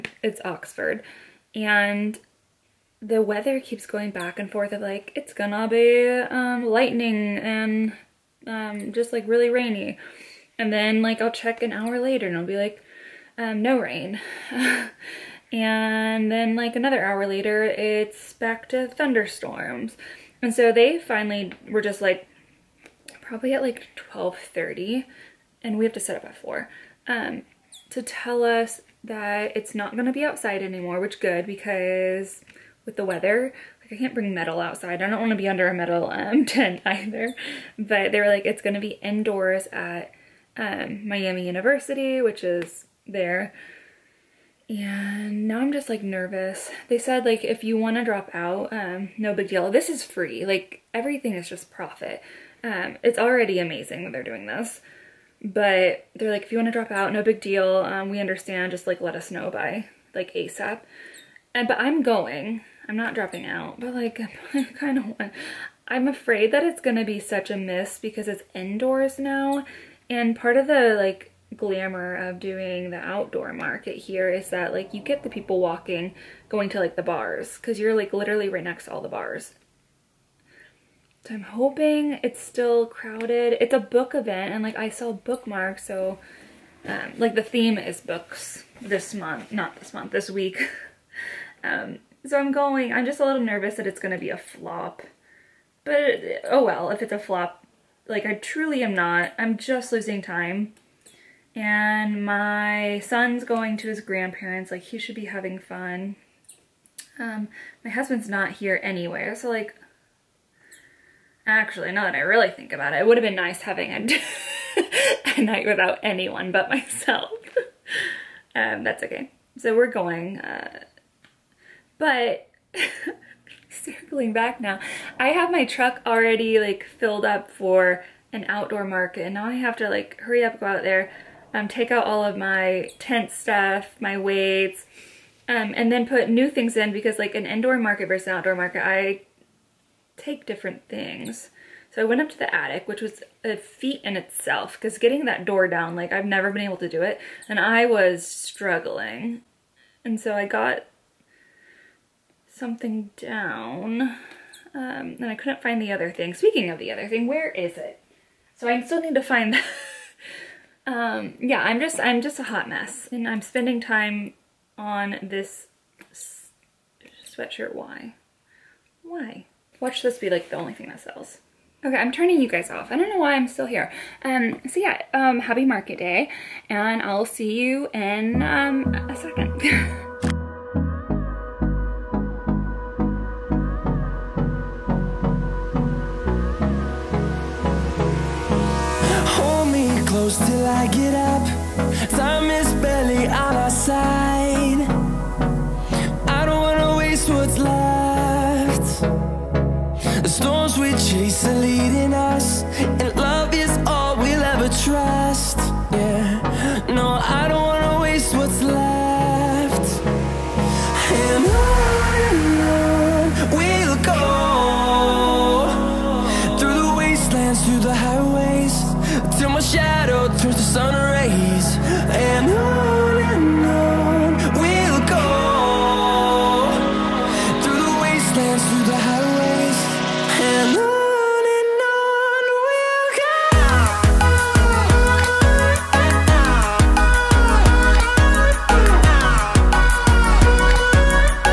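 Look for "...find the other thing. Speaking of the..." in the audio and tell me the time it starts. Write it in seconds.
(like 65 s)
155 s.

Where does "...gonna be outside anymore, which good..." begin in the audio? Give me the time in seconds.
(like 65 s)
29 s.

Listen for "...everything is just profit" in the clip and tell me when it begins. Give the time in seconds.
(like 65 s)
50 s.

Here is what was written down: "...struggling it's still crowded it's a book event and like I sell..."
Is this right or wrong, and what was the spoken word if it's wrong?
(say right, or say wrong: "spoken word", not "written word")
wrong: "hoping", not "struggling".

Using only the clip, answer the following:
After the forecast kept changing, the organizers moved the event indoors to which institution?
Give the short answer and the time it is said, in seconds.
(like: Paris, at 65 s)
Miami University, at 41 s.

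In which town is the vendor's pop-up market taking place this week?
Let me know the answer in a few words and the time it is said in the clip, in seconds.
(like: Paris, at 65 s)
Oxford, at 0 s.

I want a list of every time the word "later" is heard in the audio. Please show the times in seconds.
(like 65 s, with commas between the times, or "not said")
11 s, 17 s.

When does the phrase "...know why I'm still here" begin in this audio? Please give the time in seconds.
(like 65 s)
173 s.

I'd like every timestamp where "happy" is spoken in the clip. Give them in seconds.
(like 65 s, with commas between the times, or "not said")
175 s.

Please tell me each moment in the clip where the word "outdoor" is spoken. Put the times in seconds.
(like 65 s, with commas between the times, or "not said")
72 s, 128 s, 138 s.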